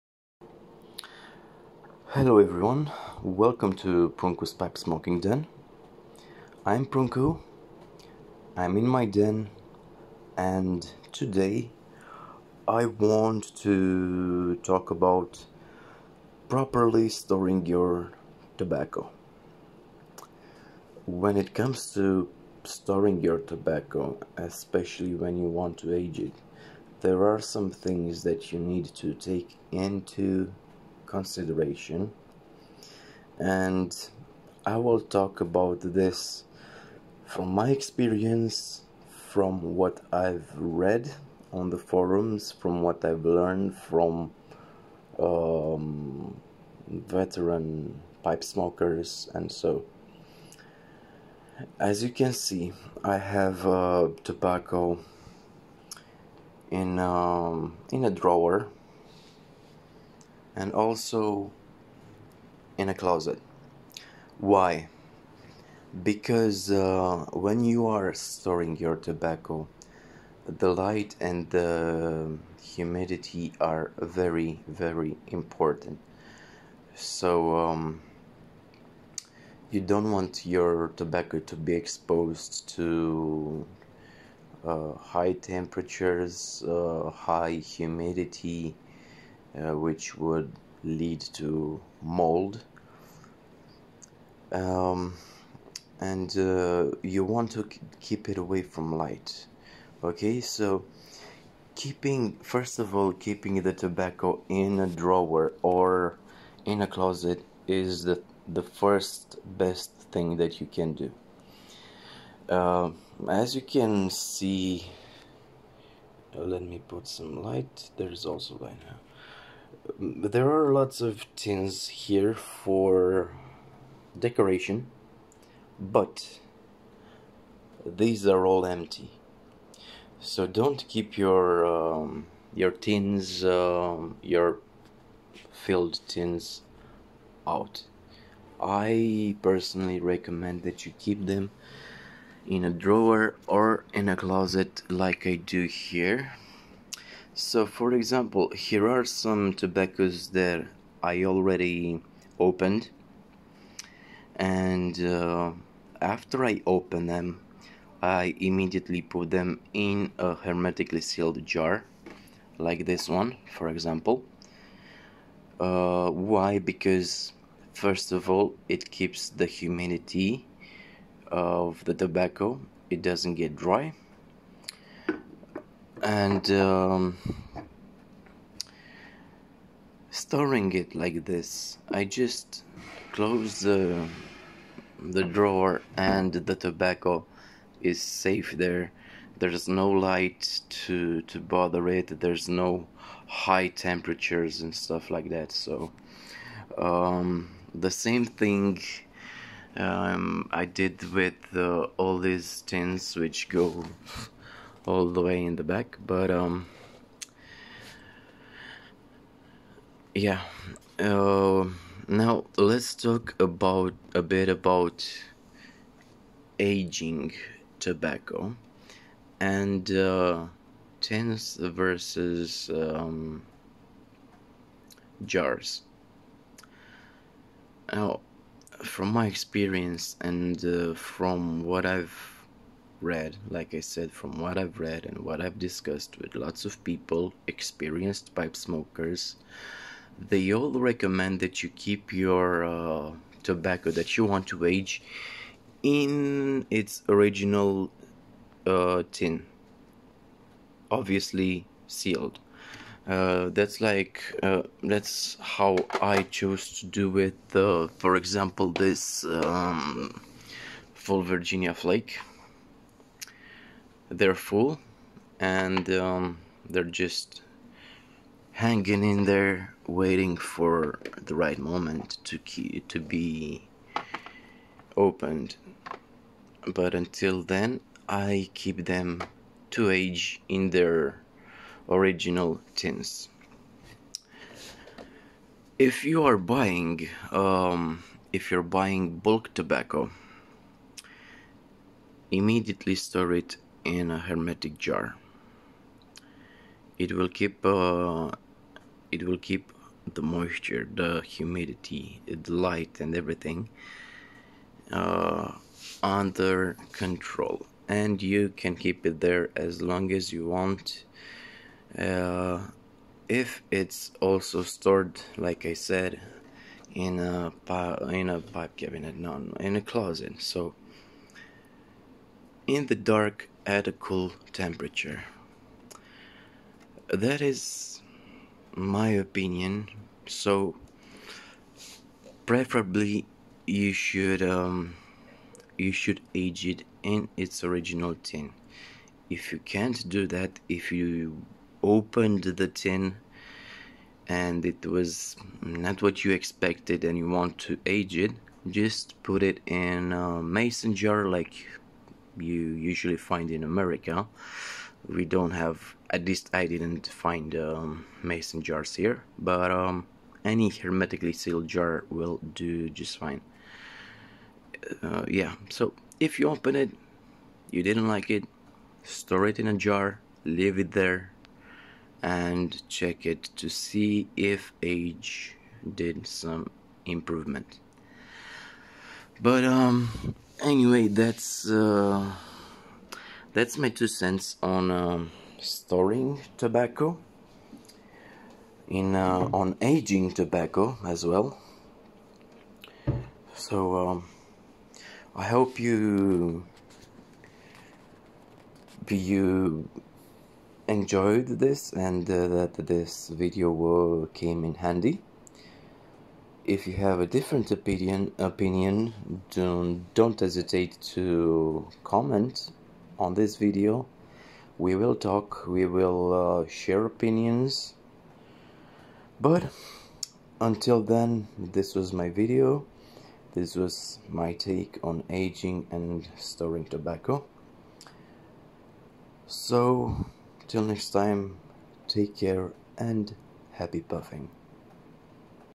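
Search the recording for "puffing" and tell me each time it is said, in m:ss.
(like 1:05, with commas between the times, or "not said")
7:14.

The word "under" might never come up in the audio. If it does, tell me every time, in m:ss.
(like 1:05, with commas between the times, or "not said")
5:06.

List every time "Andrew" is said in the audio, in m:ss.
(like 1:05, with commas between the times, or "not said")
not said.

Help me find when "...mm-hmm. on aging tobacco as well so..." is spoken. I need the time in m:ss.
6:29.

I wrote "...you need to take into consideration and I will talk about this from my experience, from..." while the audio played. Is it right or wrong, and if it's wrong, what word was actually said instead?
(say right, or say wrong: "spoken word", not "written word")
right.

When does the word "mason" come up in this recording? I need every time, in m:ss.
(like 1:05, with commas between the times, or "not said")
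5:50, 5:58.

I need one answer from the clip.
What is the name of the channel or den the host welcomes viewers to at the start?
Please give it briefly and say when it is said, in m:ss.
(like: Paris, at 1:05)
Pruncu's Pipe Smoking Den, at 0:04.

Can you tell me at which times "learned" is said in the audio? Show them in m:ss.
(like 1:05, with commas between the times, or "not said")
0:43.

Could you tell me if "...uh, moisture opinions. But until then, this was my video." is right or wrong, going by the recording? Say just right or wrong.
wrong.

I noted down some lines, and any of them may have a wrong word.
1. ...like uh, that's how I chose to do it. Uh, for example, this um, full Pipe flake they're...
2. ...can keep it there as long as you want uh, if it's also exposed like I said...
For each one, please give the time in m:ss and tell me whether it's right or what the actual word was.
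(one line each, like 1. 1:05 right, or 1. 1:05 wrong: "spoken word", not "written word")
1. 4:13 wrong: "Virginia", not "Pipe"
2. 5:08 wrong: "stored", not "exposed".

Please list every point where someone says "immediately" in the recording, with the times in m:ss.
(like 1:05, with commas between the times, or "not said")
2:38, 4:52.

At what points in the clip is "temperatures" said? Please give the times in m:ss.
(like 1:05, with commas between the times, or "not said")
1:25, 3:13, 5:24.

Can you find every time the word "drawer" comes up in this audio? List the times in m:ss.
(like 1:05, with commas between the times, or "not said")
0:58, 1:44, 2:22, 3:05.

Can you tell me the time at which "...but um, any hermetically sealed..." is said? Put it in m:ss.
5:59.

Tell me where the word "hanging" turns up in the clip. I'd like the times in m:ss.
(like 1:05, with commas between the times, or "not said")
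4:28.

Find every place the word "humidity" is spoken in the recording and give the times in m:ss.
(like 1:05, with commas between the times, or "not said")
1:12, 1:27, 2:49, 5:01.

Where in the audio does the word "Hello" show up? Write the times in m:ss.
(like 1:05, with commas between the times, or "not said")
0:02.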